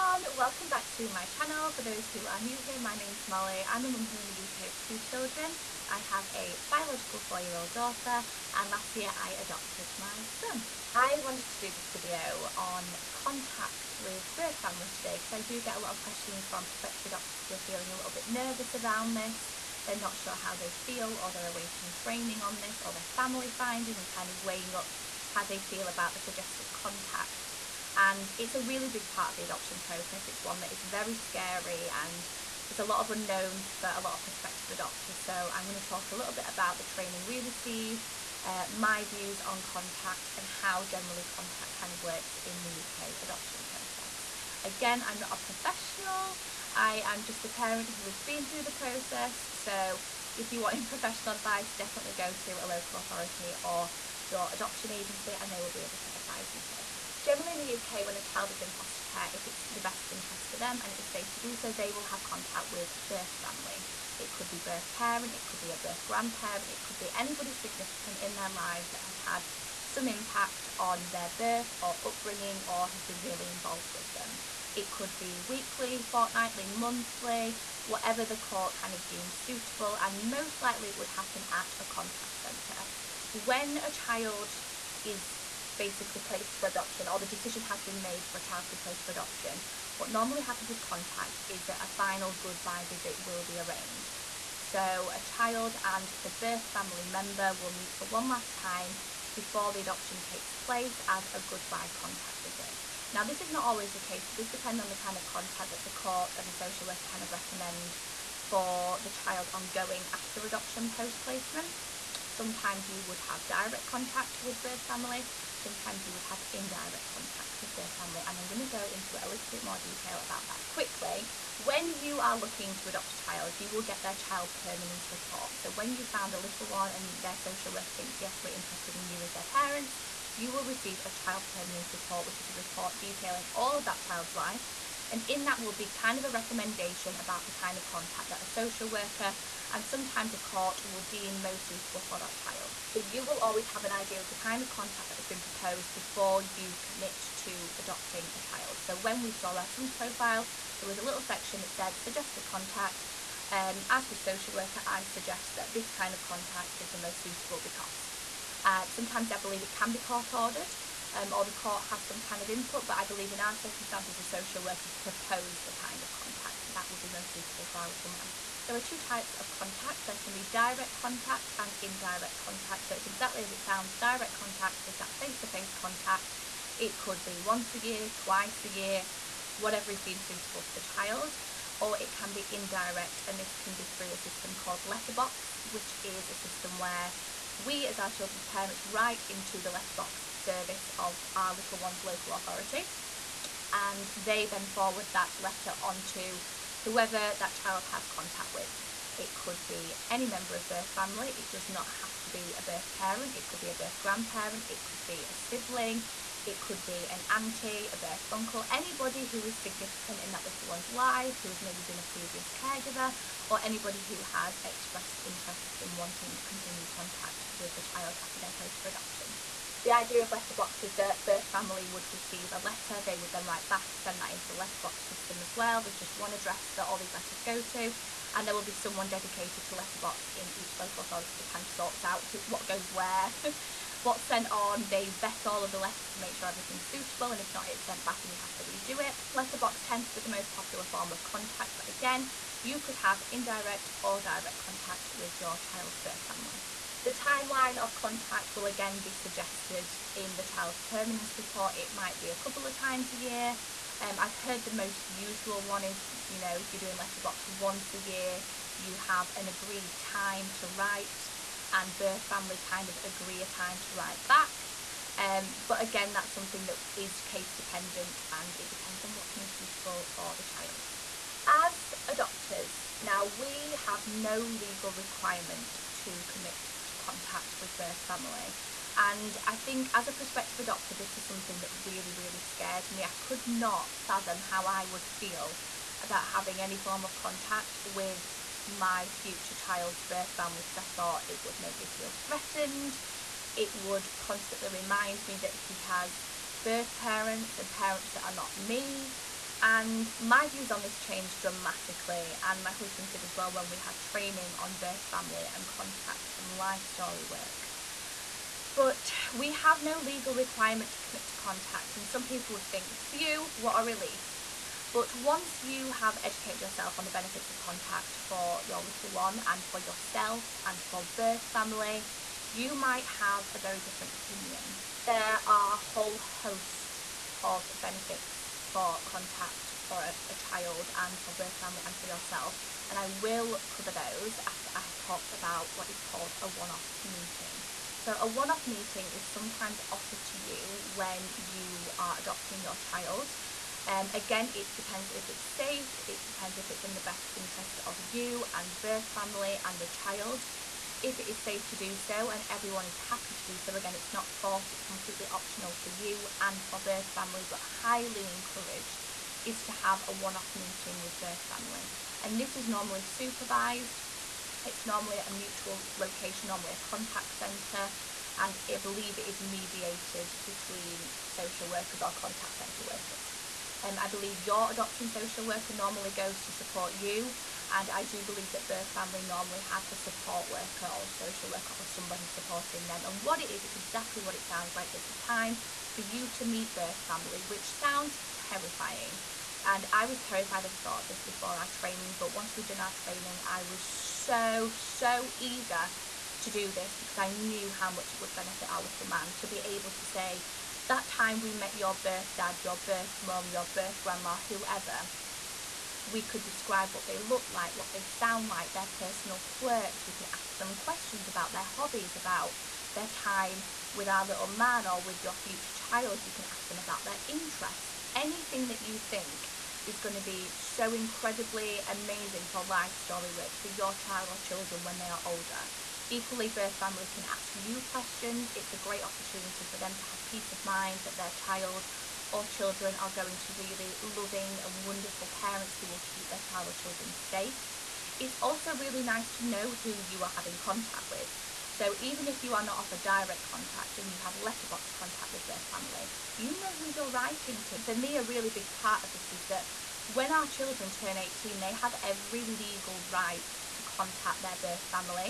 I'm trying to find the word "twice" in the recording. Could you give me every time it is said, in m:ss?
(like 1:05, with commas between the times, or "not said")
2:58.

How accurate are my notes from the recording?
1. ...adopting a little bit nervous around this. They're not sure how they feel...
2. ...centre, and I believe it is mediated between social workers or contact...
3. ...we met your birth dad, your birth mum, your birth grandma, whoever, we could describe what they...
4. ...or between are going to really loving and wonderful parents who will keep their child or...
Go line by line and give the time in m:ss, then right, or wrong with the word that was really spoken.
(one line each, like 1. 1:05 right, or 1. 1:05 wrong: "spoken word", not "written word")
1. 0:17 wrong: "feeling", not "adopting"
2. 6:07 right
3. 6:41 right
4. 7:12 wrong: "children", not "between".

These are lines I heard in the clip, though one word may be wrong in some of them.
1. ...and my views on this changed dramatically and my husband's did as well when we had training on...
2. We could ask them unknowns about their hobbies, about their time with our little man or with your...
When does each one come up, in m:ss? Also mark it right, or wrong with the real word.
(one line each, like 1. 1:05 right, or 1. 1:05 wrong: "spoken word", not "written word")
1. 4:59 right
2. 6:50 wrong: "questions", not "unknowns".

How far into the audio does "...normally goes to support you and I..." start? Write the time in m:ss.
6:15.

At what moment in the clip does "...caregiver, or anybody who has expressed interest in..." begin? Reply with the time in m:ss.
3:32.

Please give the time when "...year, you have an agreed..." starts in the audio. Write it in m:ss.
4:17.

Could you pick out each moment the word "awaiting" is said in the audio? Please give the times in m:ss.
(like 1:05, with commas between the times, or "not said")
0:21.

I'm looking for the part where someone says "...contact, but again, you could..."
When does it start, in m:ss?
4:01.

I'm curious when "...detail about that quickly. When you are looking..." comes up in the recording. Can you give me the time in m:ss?
1:59.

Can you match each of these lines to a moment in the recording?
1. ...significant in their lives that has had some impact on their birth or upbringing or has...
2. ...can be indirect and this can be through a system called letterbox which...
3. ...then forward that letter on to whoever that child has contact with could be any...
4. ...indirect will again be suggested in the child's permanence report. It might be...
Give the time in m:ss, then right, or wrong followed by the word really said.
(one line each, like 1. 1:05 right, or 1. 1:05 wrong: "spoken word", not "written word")
1. 1:07 right
2. 3:02 right
3. 3:14 right
4. 4:07 wrong: "contact", not "indirect".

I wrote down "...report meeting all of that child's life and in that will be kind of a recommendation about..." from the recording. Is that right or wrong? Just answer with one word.
wrong.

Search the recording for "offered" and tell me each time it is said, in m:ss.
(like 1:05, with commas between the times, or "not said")
5:39, 7:22.